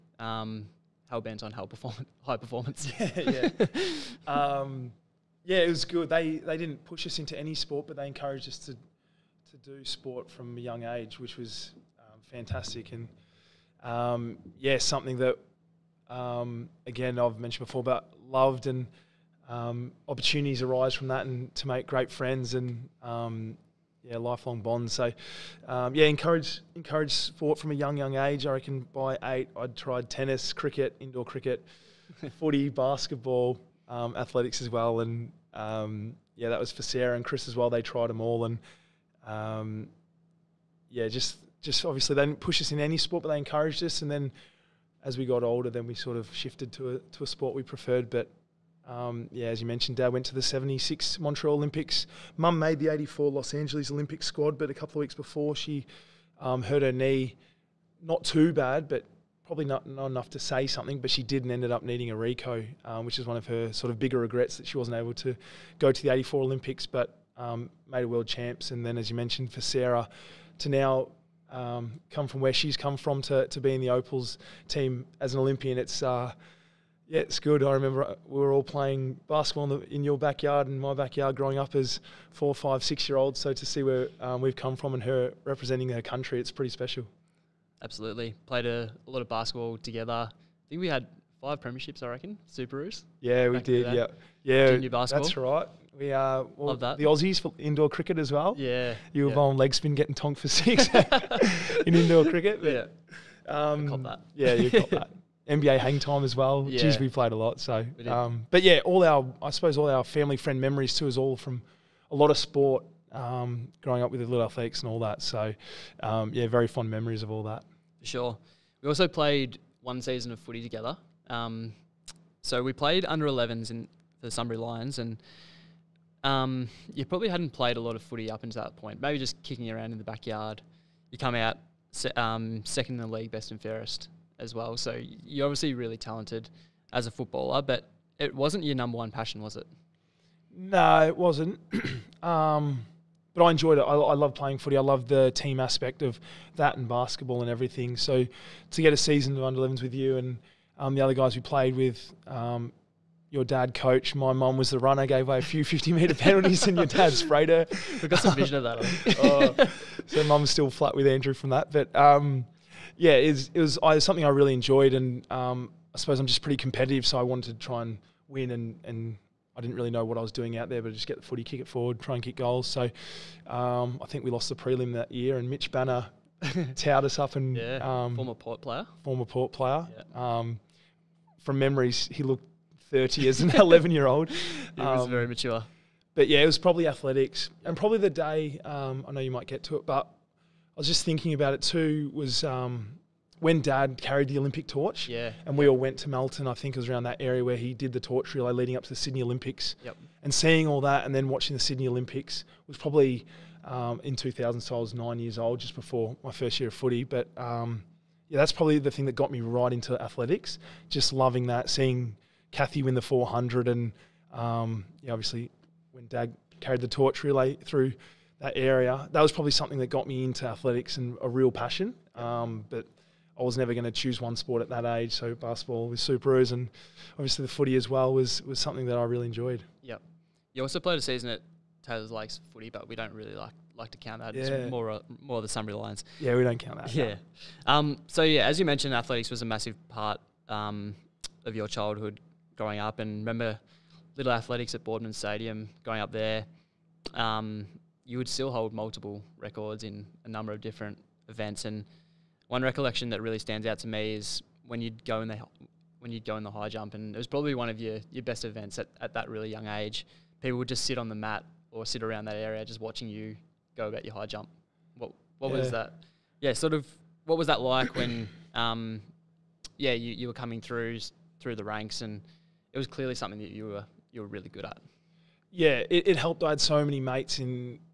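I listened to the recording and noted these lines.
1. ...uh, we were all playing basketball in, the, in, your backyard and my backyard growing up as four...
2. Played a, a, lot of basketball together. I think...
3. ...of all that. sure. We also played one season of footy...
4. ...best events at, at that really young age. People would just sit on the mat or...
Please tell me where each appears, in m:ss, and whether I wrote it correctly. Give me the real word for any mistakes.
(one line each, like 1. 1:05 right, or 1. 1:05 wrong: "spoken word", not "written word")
1. 1:18 right
2. 1:28 right
3. 1:57 right
4. 4:18 right.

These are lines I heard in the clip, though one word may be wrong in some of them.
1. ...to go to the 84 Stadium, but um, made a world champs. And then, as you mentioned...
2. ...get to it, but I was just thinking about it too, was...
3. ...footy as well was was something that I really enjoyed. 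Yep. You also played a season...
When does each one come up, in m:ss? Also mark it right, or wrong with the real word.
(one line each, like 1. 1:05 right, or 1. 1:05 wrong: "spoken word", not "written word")
1. 1:05 wrong: "Olympics", not "Stadium"
2. 3:09 right
3. 3:47 right.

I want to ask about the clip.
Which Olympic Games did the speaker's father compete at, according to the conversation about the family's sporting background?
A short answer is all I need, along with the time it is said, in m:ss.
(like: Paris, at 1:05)
1976 Montreal Olympics, at 0:50.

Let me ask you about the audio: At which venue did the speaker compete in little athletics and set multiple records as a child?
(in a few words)
Boardman Stadium.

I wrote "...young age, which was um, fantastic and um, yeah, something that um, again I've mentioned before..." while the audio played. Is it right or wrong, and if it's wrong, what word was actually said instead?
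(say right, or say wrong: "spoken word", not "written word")
right.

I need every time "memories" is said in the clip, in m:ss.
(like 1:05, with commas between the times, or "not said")
1:50, 1:56, 3:01.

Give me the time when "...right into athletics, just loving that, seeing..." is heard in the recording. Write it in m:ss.
3:29.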